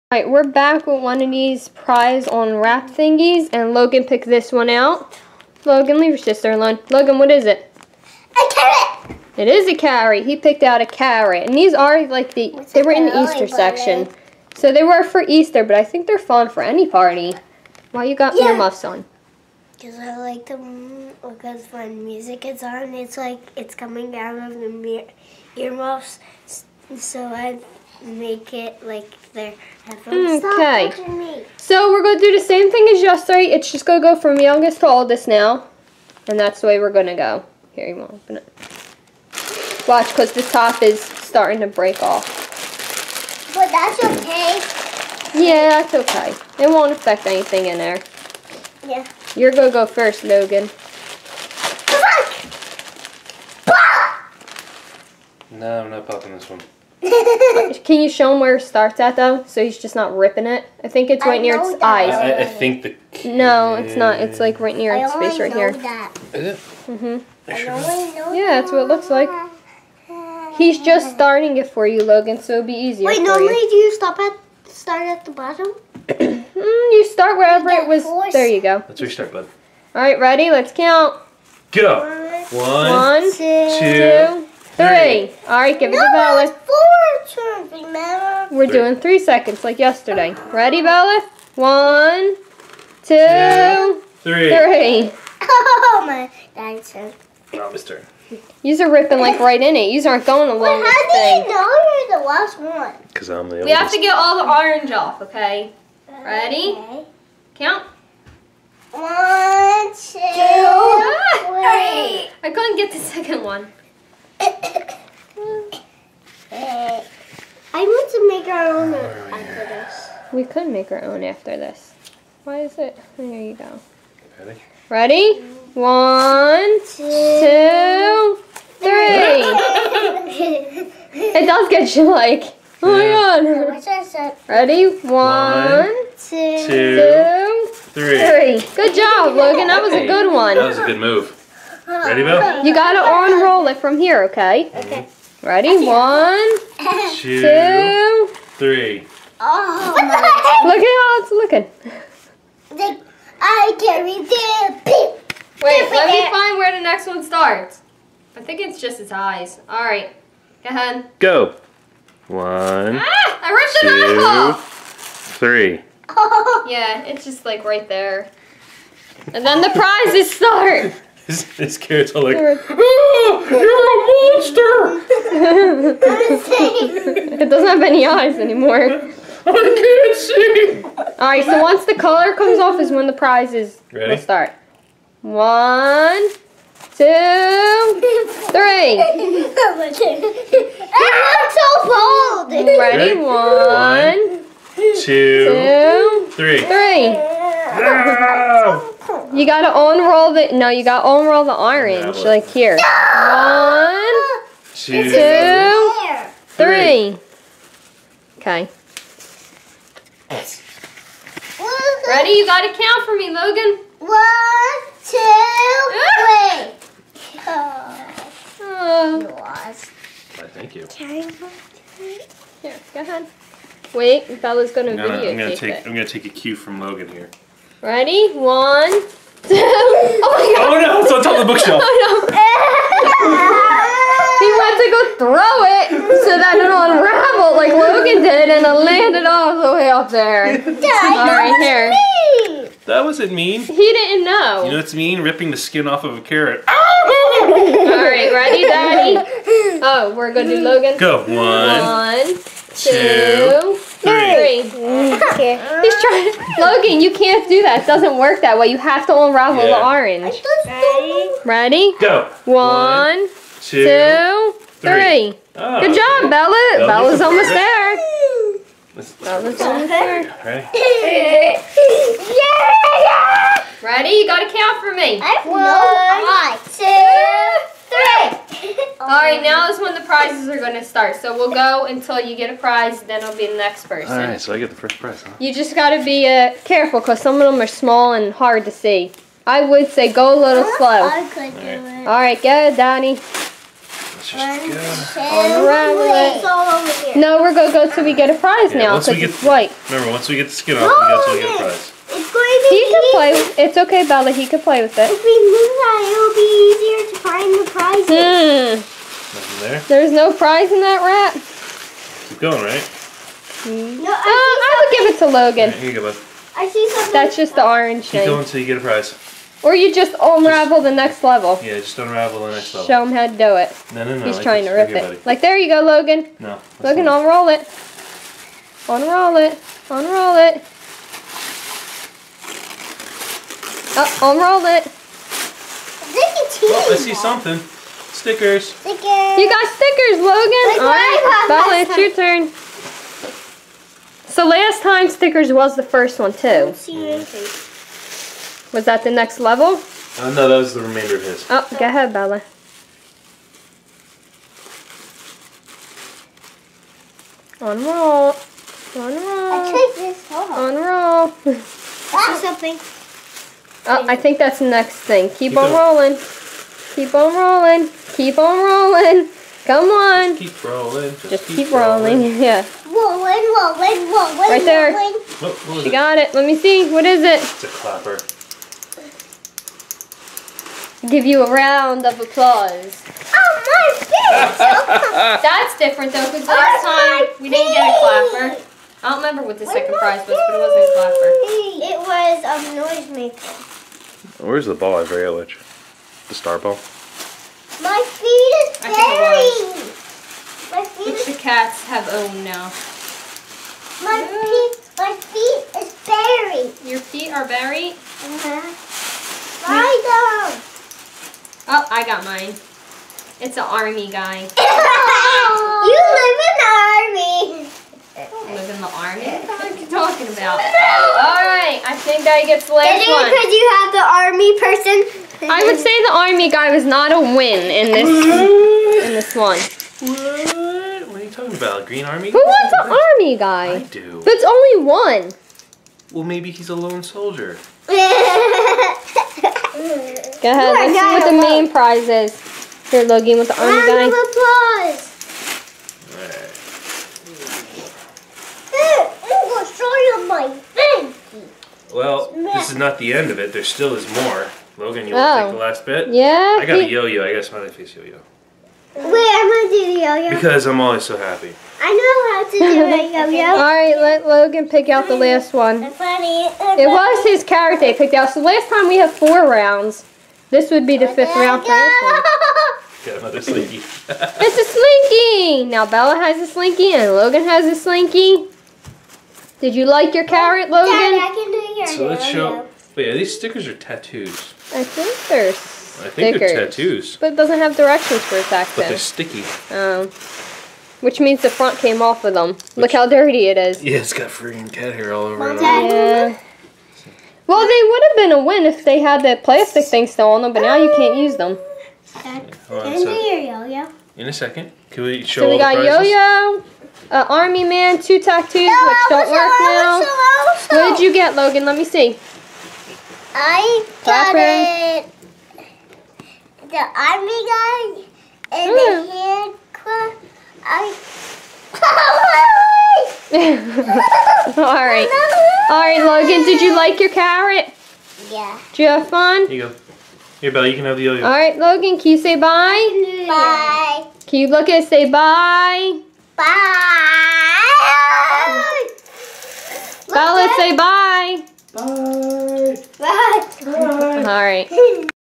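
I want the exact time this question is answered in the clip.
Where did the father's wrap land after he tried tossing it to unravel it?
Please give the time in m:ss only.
3:51.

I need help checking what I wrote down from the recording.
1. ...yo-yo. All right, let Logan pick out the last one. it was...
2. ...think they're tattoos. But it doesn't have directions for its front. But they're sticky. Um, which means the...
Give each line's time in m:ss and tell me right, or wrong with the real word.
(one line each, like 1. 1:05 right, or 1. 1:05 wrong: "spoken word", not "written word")
1. 7:43 right
2. 8:06 wrong: "accent", not "front".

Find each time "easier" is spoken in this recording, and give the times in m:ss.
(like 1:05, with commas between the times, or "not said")
1:12, 5:07.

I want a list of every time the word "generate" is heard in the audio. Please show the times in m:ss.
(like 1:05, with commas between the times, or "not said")
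not said.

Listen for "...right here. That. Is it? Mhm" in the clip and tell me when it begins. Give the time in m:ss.
1:05.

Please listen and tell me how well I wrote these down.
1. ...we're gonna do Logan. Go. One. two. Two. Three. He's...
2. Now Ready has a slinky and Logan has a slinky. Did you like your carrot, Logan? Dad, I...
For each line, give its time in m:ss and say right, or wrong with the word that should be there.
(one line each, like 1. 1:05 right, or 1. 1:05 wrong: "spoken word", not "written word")
1. 4:10 wrong: "Three", not "Two"
2. 7:55 wrong: "Bella", not "Ready".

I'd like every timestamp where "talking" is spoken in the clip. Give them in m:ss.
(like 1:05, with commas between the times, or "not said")
6:59, 7:11.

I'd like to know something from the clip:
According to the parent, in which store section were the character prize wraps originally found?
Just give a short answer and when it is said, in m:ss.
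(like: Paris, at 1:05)
Easter section, at 0:13.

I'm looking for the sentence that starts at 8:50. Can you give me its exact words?
Here, Bella, you can have the yo-yo.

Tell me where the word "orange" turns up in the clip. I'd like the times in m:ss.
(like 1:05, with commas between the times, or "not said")
1:44, 3:21, 4:19, 5:17.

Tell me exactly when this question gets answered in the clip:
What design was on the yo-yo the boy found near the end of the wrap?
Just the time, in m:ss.
7:37.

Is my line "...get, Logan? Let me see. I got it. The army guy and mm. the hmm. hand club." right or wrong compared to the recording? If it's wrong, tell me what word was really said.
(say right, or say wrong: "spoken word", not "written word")
right.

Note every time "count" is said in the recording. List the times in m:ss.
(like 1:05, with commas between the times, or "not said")
1:20, 1:47, 3:32, 4:34.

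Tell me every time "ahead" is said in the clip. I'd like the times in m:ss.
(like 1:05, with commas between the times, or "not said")
2:40, 3:42, 5:51, 7:17.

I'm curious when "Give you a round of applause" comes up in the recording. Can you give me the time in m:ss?
6:21.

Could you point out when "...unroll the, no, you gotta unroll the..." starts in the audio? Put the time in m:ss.
3:19.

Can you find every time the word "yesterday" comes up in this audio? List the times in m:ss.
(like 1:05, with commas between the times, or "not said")
0:33, 1:29.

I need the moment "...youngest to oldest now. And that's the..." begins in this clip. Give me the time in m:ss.
0:34.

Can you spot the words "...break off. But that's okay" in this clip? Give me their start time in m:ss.
0:41.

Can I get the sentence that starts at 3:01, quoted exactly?
Alright, so once the color comes off is when the prizes Ready?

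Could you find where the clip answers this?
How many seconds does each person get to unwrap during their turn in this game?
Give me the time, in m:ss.
1:28.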